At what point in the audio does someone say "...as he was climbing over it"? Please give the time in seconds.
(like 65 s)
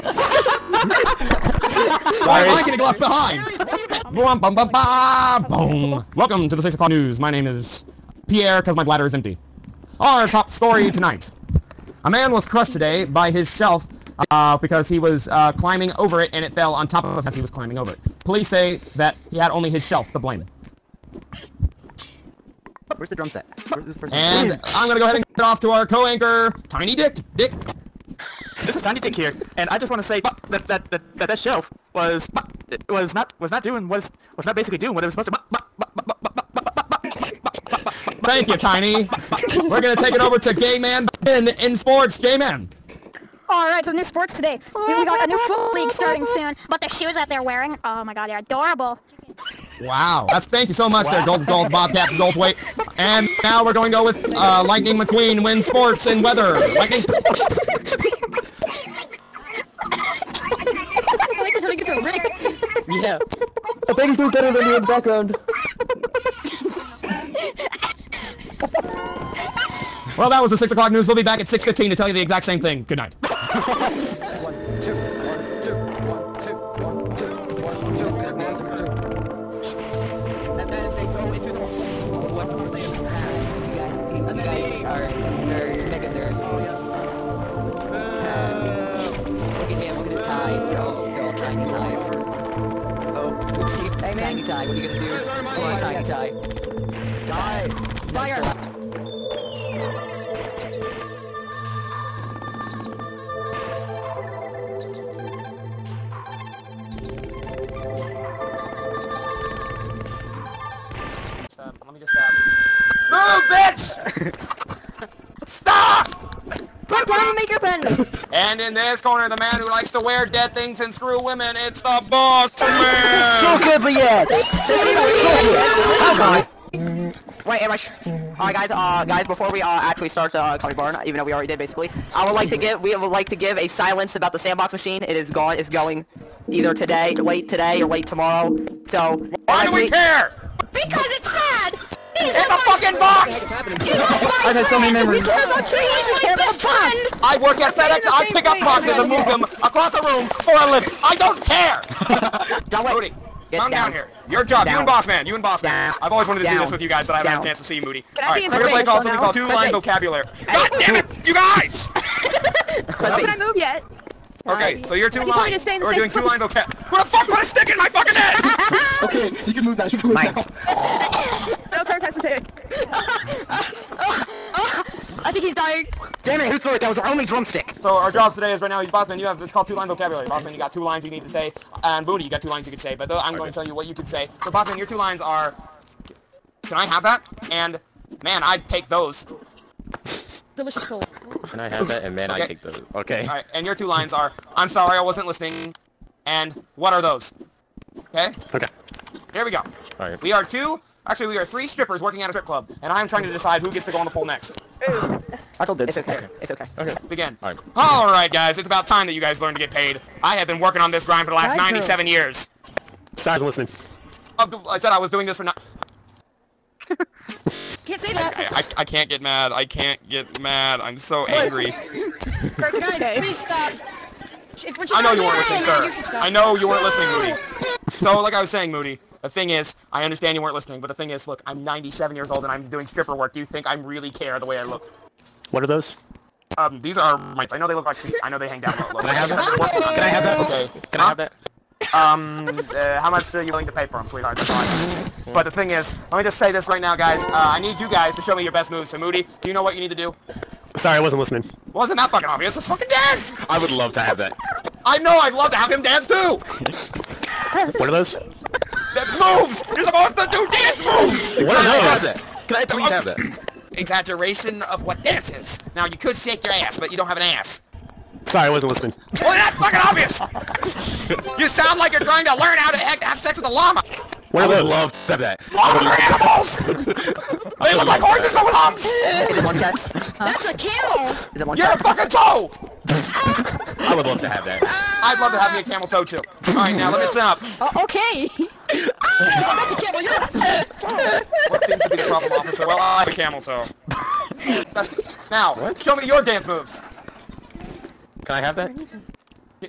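17 s.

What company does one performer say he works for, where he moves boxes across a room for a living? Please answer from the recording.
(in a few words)
FedEx.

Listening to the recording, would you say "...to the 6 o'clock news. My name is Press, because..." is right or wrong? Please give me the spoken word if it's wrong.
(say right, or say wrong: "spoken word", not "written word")
wrong: "Pierre", not "Press".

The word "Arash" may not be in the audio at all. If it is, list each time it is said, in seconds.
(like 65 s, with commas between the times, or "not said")
127 s.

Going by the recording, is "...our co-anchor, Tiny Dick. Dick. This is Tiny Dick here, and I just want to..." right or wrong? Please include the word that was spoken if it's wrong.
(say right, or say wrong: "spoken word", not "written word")
right.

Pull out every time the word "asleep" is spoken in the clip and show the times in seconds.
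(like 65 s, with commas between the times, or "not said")
not said.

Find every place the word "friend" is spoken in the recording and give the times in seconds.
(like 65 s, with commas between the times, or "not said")
146 s.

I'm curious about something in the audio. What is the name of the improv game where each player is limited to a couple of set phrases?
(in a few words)
Two-line vocabulary.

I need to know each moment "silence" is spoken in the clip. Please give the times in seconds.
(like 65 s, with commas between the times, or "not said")
133 s.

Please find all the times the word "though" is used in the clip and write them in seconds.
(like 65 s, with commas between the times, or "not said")
131 s, 183 s.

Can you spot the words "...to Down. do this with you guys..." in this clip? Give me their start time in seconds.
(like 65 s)
156 s.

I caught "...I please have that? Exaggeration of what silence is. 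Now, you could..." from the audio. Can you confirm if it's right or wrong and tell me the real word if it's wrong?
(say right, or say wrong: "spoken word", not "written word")
wrong: "dance", not "silence".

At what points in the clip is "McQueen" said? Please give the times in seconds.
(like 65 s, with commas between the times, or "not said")
54 s.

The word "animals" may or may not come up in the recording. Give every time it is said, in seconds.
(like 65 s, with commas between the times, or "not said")
276 s.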